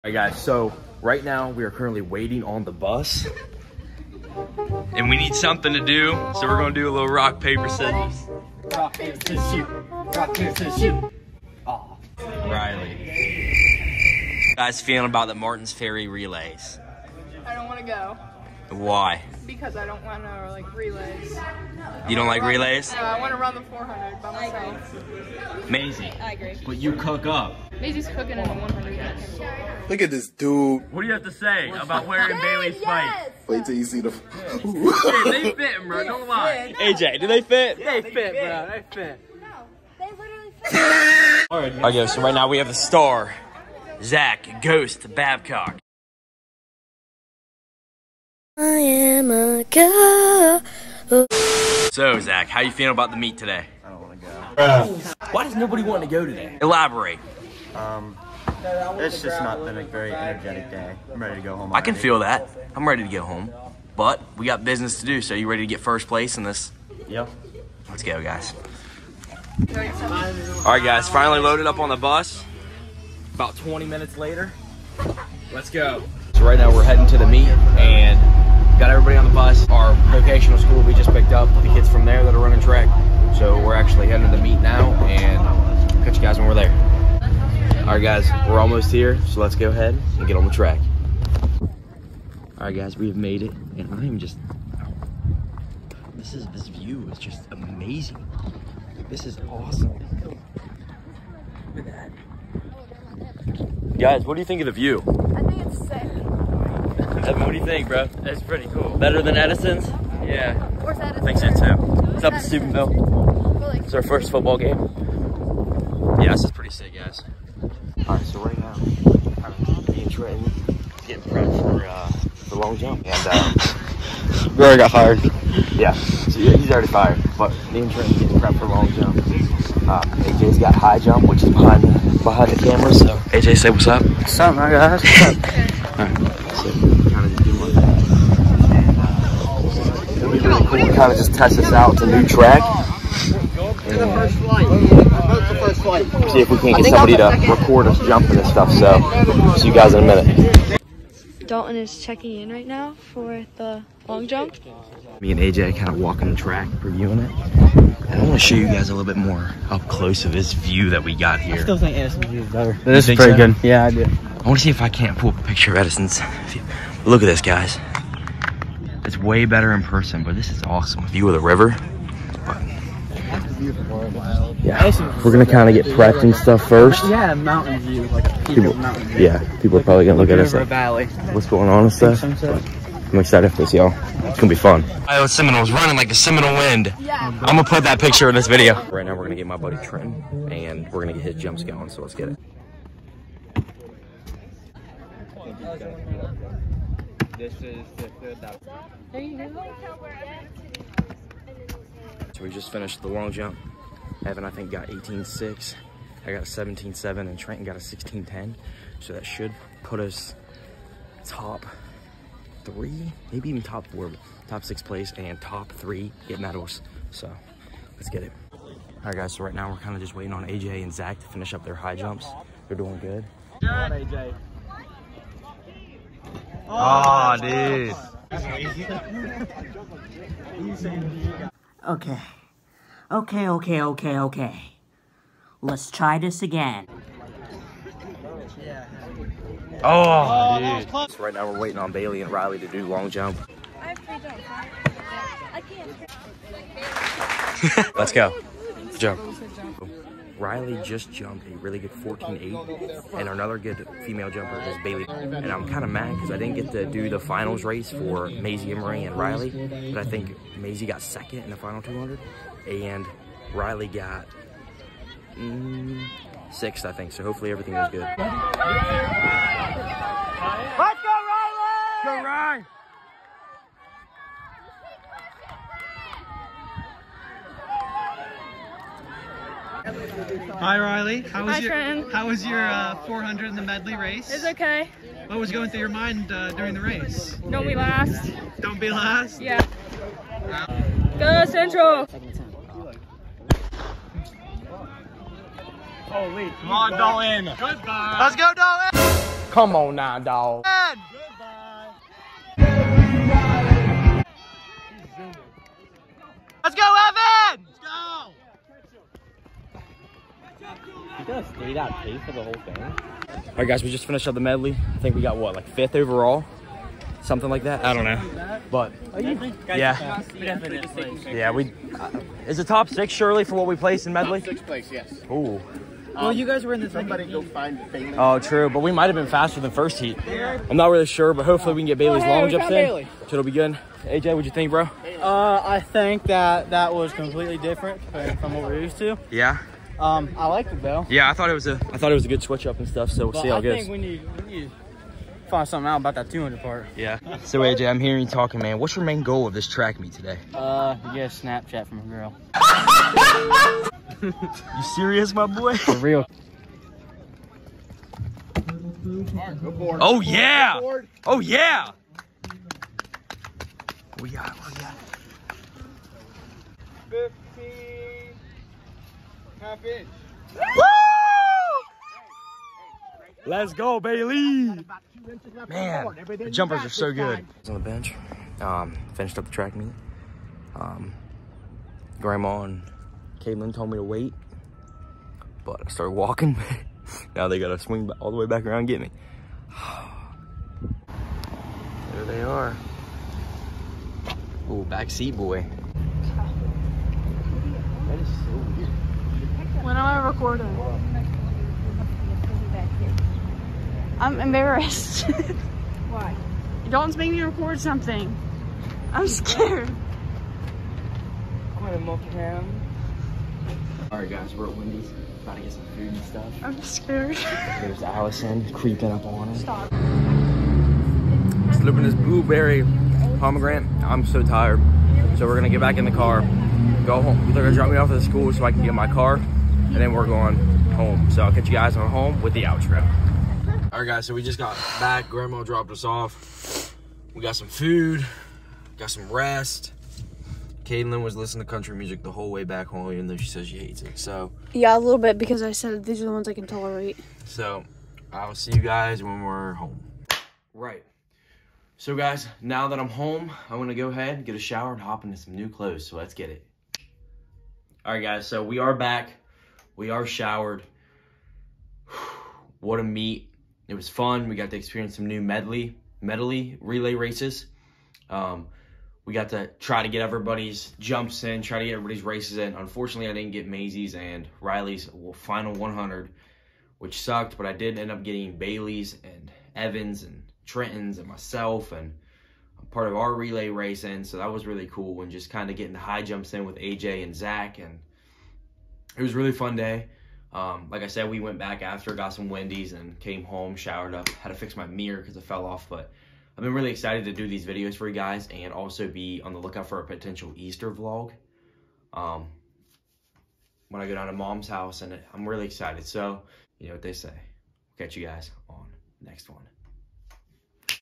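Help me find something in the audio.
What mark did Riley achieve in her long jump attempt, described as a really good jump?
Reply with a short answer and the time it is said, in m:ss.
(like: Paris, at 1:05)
14.8, at 4:11.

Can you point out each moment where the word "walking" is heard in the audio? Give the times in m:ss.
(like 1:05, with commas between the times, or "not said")
2:35, 6:26.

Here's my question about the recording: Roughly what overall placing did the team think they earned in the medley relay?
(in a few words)
Fifth.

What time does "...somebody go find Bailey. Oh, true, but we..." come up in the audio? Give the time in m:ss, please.
5:26.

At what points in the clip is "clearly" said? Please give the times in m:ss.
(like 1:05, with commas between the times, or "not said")
not said.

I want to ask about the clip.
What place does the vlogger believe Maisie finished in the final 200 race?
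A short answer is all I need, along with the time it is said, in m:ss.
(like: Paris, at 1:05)
Second, at 4:21.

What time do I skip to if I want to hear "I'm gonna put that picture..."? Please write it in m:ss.
3:07.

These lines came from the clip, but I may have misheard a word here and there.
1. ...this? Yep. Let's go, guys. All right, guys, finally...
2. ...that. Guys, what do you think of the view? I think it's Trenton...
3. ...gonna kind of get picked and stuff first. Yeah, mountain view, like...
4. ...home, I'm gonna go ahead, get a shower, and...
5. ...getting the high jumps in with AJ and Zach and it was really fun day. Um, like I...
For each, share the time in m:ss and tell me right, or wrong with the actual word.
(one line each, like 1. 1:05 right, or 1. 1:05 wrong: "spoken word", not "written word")
1. 1:06 right
2. 1:43 wrong: "Evan", not "Trenton"
3. 2:55 wrong: "prepped", not "picked"
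4. 7:33 right
5. 8:05 right.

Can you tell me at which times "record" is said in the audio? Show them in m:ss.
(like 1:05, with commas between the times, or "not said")
2:27, 6:47.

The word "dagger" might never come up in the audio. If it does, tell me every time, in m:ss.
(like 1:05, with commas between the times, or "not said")
not said.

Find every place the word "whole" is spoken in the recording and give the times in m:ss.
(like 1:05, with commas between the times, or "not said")
5:12, 7:22.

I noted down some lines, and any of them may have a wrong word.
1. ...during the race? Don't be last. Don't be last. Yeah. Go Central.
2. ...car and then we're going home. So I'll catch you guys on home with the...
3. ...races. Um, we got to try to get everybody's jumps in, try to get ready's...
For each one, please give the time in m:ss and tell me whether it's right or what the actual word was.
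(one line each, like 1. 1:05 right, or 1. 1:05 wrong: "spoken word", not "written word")
1. 4:46 right
2. 7:09 right
3. 7:47 wrong: "everybody", not "ready".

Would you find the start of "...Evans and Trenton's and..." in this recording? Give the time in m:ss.
7:59.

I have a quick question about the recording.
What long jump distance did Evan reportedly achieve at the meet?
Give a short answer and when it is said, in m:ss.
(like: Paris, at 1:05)
18.6, at 3:24.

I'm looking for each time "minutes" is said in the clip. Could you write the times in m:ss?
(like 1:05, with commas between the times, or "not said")
1:13, 2:30.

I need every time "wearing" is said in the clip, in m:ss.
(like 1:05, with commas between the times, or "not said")
0:32.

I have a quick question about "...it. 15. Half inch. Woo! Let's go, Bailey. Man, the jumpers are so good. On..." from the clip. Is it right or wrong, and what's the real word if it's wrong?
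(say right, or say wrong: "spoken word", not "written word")
right.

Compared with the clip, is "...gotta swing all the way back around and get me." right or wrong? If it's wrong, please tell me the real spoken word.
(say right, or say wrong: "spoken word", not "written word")
right.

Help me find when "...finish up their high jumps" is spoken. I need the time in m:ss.
3:41.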